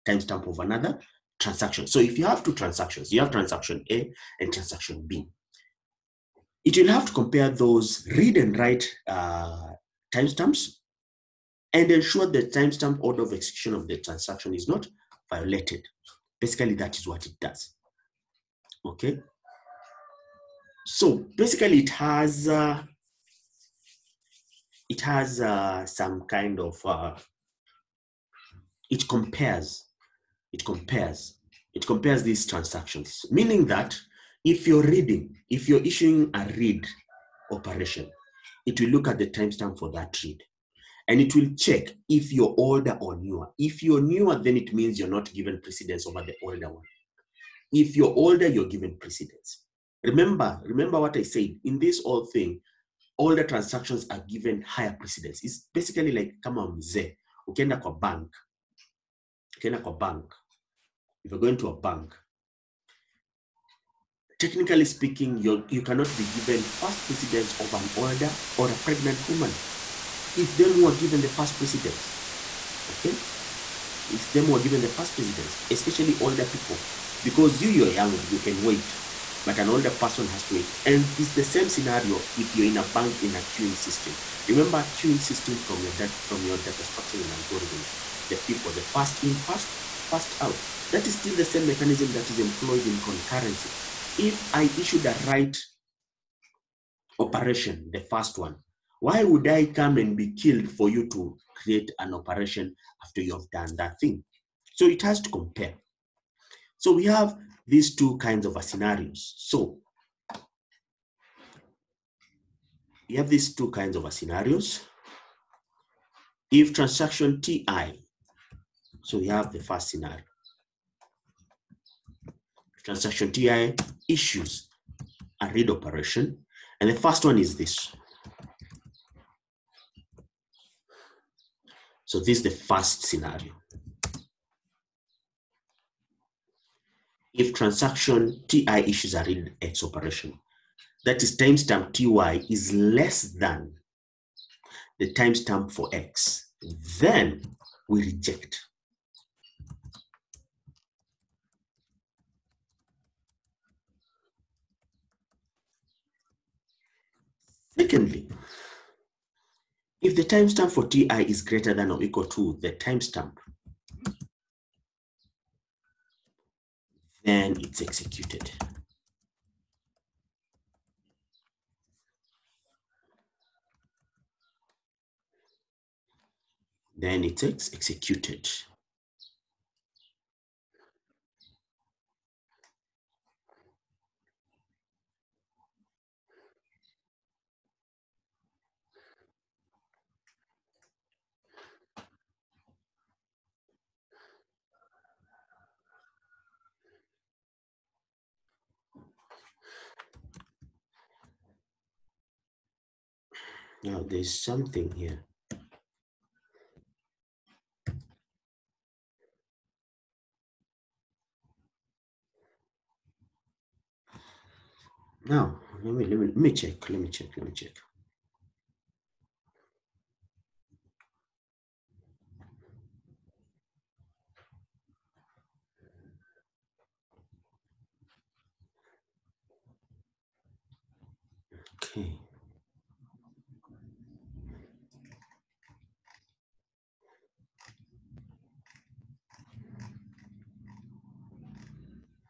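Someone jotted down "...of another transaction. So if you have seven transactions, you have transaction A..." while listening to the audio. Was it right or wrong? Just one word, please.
wrong.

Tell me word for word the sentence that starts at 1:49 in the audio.
So you have these two kinds of scenarios.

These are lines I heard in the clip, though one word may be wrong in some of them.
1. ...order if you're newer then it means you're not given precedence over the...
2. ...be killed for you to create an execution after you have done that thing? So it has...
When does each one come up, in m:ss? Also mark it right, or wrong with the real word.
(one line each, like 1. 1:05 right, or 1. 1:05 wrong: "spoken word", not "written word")
1. 0:43 wrong: "newer", not "order"
2. 1:40 wrong: "operation", not "execution".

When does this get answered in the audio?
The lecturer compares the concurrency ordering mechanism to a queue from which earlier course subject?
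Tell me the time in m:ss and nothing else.
1:26.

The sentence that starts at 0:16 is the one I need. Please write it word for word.
Basically, that is what it does.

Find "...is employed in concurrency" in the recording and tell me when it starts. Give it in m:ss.
1:32.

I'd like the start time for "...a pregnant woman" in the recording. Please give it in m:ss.
1:08.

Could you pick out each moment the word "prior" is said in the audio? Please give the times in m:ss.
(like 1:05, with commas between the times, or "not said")
not said.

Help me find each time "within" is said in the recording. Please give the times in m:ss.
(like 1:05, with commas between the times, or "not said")
not said.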